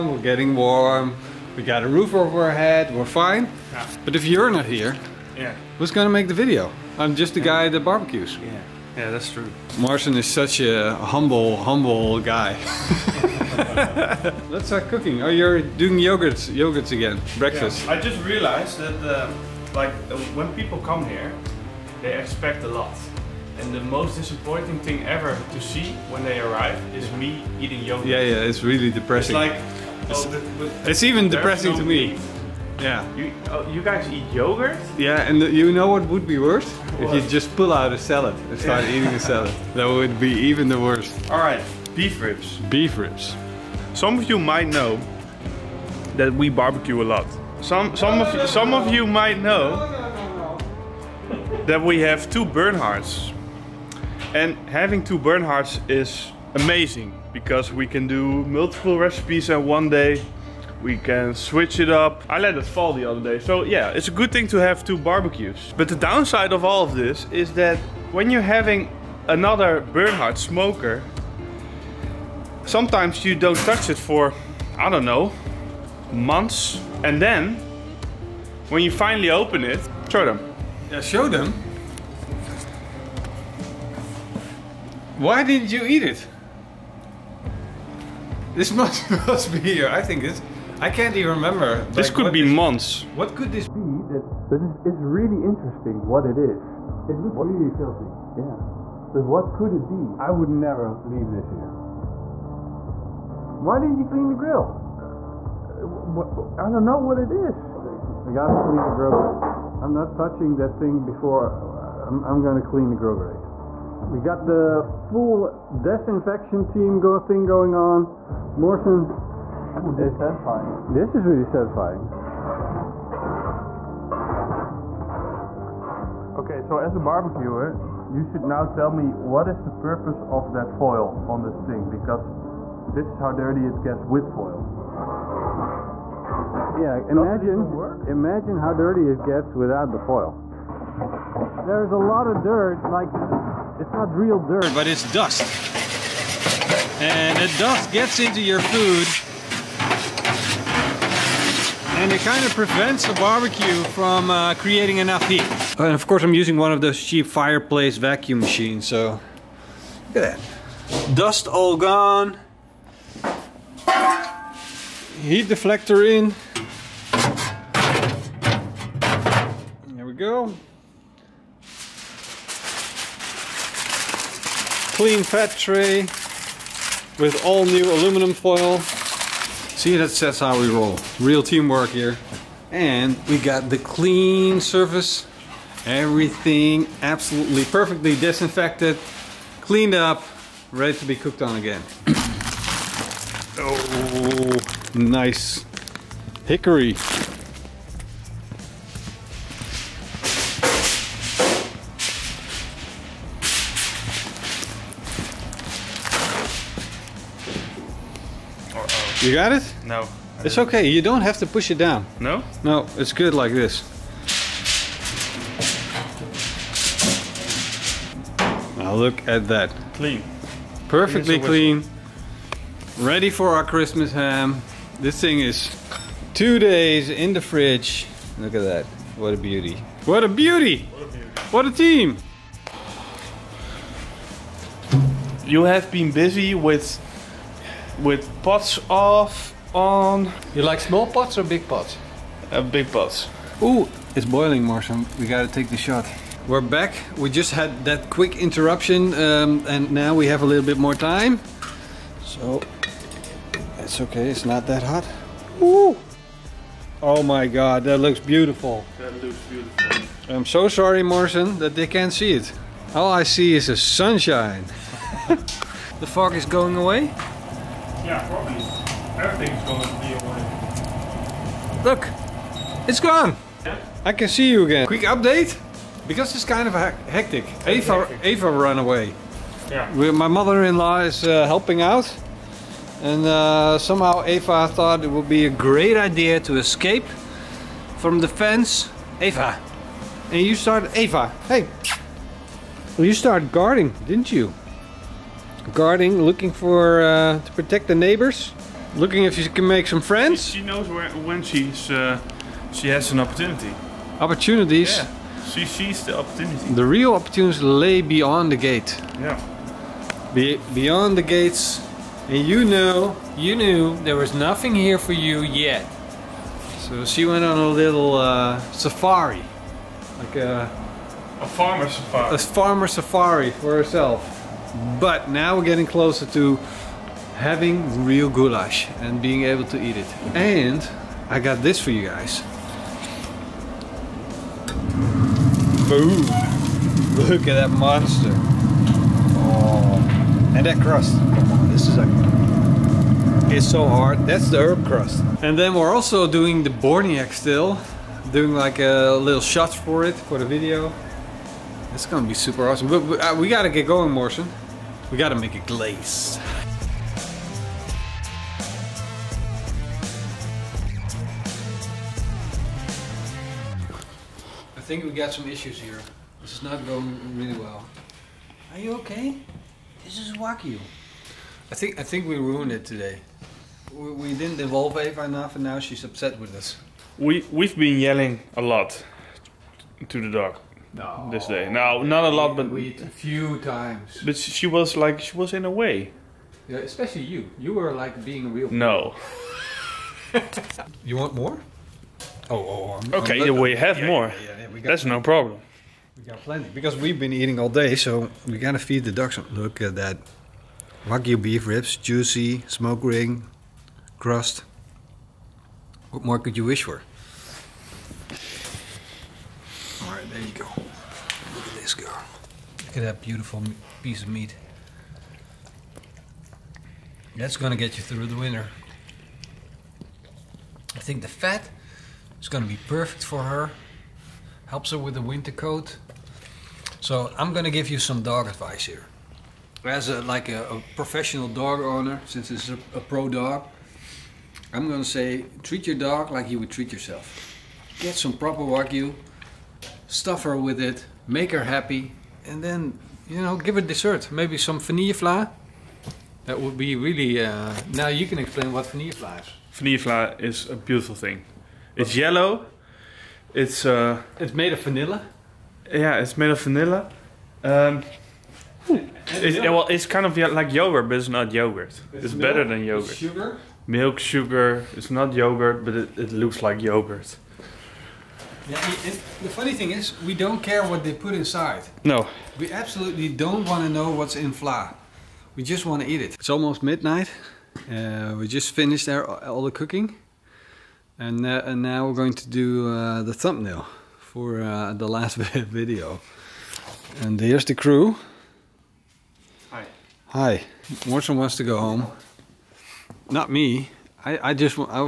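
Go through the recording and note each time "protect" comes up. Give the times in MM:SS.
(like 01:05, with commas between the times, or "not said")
04:57.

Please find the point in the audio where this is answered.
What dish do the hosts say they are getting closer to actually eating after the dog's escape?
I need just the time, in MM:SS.
05:28.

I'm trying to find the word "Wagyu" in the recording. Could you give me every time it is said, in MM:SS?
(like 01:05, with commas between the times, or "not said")
06:41, 07:18.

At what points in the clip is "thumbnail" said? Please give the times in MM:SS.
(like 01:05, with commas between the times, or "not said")
08:03.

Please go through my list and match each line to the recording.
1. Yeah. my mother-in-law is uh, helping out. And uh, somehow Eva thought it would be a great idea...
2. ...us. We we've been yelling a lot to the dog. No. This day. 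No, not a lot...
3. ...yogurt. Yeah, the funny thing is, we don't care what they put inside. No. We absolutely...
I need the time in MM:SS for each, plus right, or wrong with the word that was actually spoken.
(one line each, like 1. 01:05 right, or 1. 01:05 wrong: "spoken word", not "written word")
1. 04:39 right
2. 06:16 right
3. 07:46 right.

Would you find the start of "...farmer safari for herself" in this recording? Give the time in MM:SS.
05:22.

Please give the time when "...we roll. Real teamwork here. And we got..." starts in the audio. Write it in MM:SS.
03:00.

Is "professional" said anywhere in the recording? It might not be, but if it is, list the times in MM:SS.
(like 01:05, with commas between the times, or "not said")
07:10.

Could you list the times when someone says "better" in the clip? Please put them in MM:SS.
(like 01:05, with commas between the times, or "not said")
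07:42.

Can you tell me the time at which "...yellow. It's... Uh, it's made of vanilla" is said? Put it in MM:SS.
07:32.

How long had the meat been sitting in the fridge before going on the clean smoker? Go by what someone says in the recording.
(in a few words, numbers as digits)
Two days.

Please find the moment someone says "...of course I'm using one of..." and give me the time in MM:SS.
02:35.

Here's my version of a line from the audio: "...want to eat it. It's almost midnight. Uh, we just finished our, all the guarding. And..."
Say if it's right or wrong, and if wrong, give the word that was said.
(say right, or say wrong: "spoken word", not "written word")
wrong: "cooking", not "guarding".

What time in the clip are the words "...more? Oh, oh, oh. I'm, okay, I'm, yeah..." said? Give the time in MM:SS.
06:31.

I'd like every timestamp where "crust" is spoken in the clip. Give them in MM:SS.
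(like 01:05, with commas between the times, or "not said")
05:40, 05:44, 06:44.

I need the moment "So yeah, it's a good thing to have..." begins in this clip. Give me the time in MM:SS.
01:03.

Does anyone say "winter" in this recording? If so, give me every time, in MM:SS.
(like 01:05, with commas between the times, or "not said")
06:58, 07:05.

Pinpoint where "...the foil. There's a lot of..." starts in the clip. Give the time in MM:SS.
02:19.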